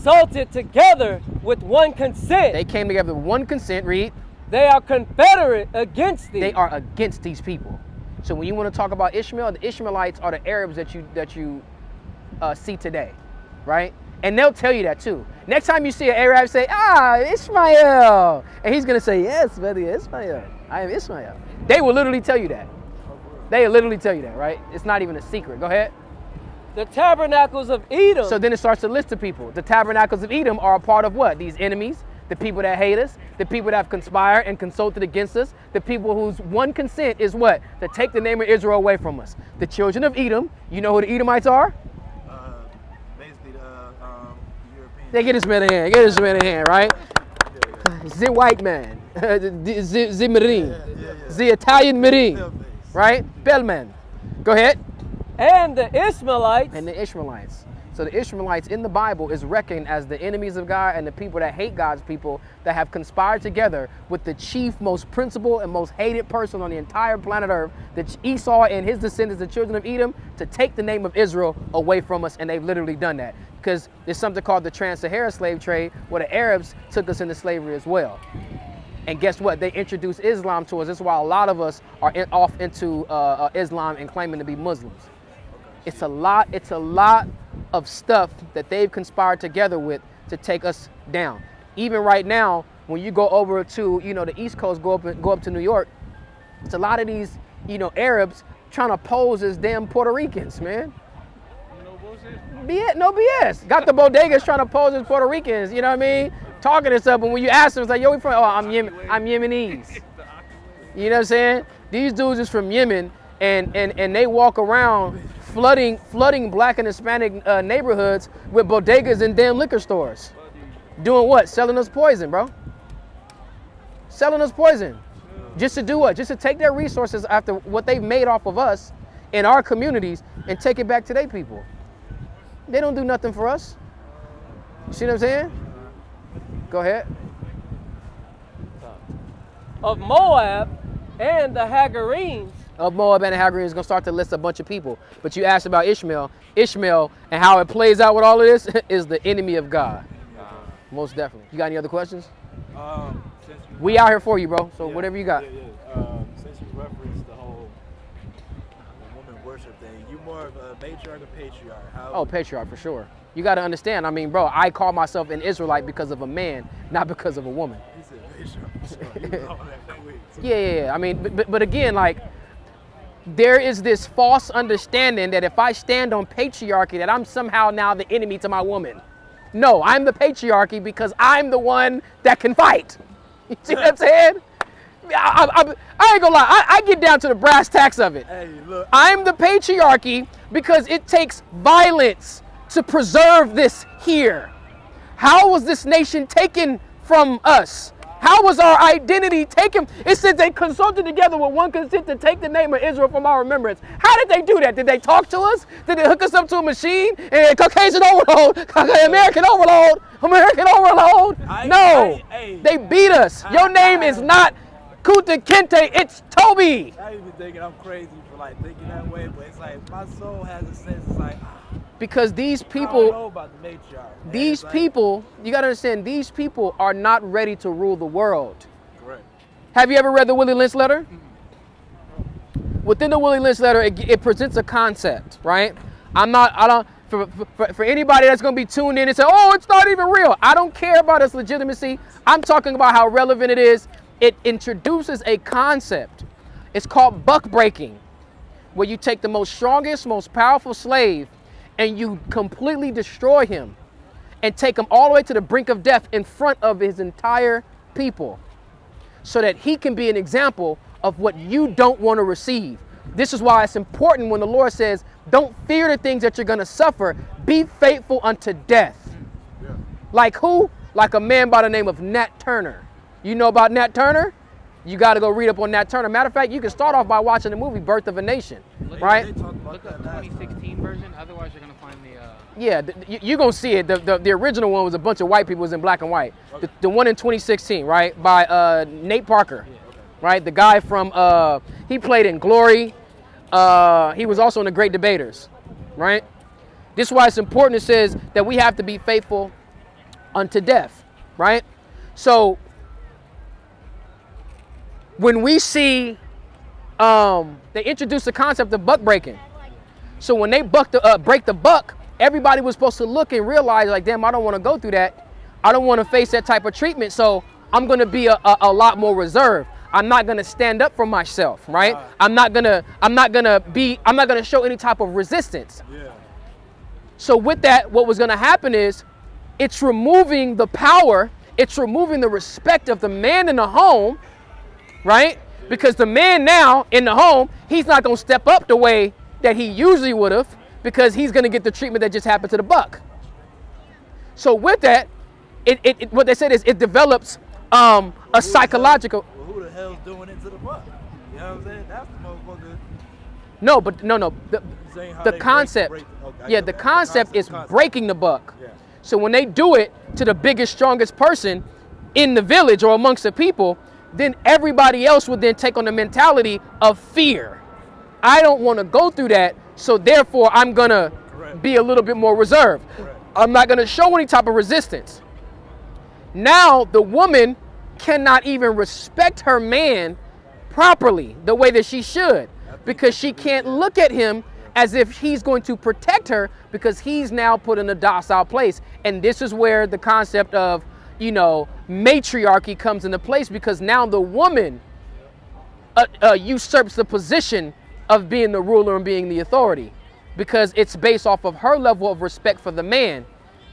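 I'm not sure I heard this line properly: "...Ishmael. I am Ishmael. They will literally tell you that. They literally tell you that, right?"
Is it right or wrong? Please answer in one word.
right.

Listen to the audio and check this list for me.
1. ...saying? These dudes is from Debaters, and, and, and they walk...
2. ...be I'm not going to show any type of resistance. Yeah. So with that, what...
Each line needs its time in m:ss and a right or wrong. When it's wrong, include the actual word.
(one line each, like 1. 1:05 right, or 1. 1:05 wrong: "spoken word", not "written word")
1. 1:51 wrong: "Yemen", not "Debaters"
2. 5:23 right.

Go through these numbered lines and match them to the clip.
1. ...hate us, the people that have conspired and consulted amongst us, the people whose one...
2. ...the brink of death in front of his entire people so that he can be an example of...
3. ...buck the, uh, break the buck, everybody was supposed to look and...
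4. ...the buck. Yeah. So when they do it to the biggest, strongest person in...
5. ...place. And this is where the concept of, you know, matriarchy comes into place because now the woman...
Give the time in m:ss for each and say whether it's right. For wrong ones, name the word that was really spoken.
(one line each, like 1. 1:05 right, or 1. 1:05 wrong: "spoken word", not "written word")
1. 0:32 wrong: "against", not "amongst"
2. 4:15 right
3. 5:10 right
4. 5:58 right
5. 6:28 right.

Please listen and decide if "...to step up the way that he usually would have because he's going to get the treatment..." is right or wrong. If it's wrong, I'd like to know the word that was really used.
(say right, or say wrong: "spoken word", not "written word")
right.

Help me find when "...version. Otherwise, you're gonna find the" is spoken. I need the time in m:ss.
4:40.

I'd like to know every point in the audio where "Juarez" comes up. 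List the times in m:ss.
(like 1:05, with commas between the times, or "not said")
not said.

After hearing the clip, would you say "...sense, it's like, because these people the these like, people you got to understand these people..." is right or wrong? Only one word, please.
right.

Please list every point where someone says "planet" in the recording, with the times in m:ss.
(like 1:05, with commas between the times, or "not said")
1:07.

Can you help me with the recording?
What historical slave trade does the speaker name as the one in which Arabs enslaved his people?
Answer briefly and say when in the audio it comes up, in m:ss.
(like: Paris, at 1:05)
Trans-Saharan slave trade, at 1:14.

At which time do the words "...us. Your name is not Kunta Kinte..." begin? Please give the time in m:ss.
3:33.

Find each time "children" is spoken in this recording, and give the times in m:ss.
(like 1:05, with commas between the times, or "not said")
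0:39, 1:09.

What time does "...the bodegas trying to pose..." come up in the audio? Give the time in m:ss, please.
1:43.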